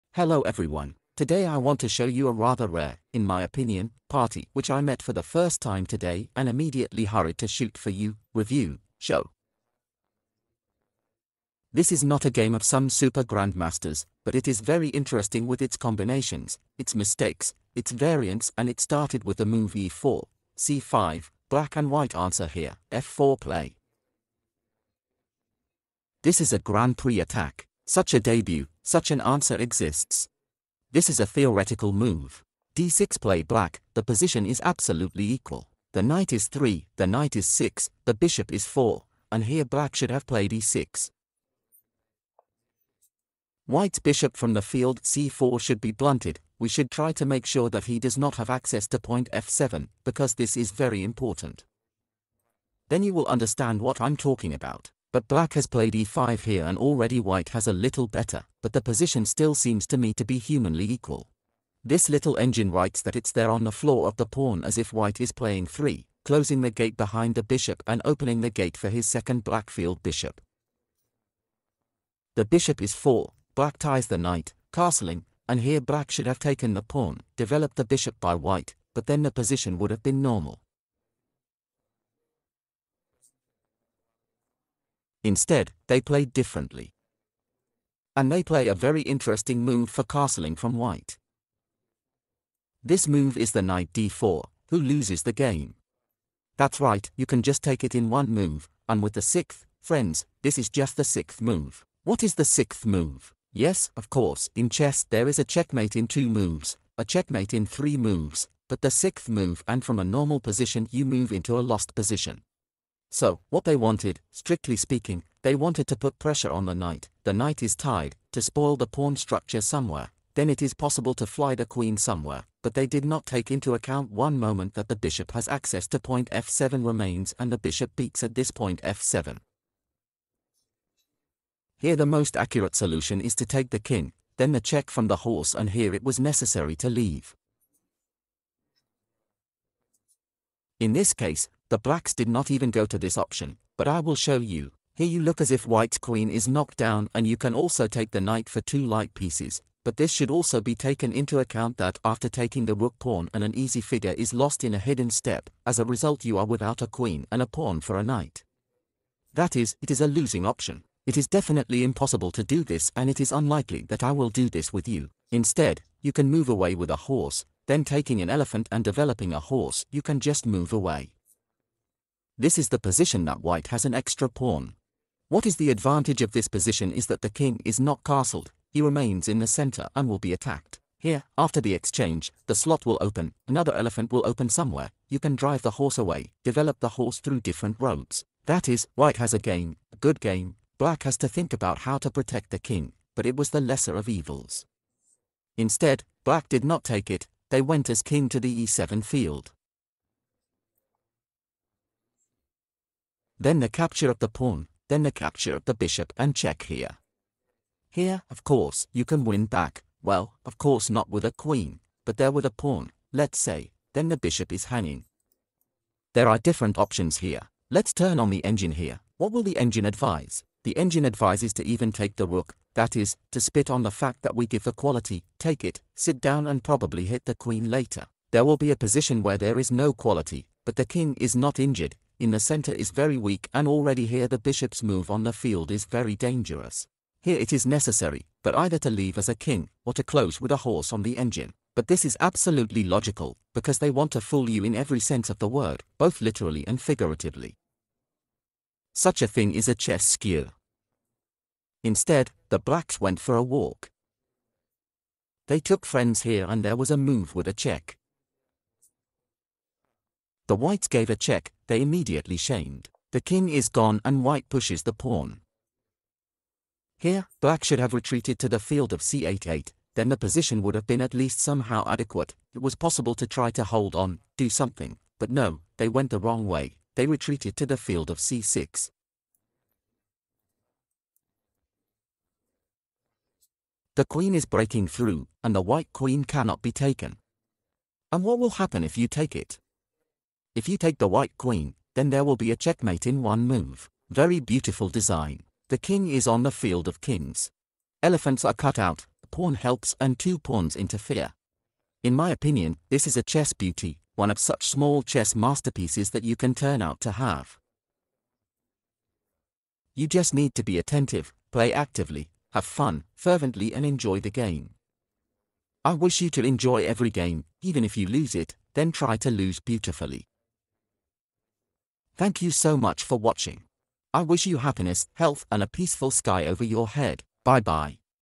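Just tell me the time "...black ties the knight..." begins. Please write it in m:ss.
1:13.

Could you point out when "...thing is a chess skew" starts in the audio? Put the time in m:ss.
4:09.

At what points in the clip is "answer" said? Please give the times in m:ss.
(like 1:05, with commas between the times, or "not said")
0:22, 0:29.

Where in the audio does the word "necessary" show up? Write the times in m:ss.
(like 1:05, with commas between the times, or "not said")
2:16, 3:57.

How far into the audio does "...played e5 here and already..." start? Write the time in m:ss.
0:55.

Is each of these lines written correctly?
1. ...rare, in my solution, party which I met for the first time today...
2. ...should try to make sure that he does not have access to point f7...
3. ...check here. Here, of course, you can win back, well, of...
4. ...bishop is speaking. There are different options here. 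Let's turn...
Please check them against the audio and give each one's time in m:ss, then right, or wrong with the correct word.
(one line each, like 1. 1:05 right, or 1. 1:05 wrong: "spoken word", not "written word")
1. 0:02 wrong: "opinion", not "solution"
2. 0:46 right
3. 3:26 right
4. 3:34 wrong: "hanging", not "speaking".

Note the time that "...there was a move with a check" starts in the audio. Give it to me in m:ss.
4:16.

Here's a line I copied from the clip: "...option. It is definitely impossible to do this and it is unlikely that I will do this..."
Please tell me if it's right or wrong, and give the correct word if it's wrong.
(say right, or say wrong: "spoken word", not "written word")
right.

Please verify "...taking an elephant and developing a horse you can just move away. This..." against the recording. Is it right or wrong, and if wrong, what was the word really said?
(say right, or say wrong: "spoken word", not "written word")
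right.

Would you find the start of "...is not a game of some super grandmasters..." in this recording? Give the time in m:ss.
0:11.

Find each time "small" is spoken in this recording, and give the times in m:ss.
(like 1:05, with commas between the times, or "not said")
5:04.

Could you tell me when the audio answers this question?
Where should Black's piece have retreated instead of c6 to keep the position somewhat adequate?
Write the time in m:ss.
4:29.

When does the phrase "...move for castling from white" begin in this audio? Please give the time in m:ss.
1:29.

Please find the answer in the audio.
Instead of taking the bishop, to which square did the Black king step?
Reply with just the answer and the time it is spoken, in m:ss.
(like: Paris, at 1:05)
e7, at 3:18.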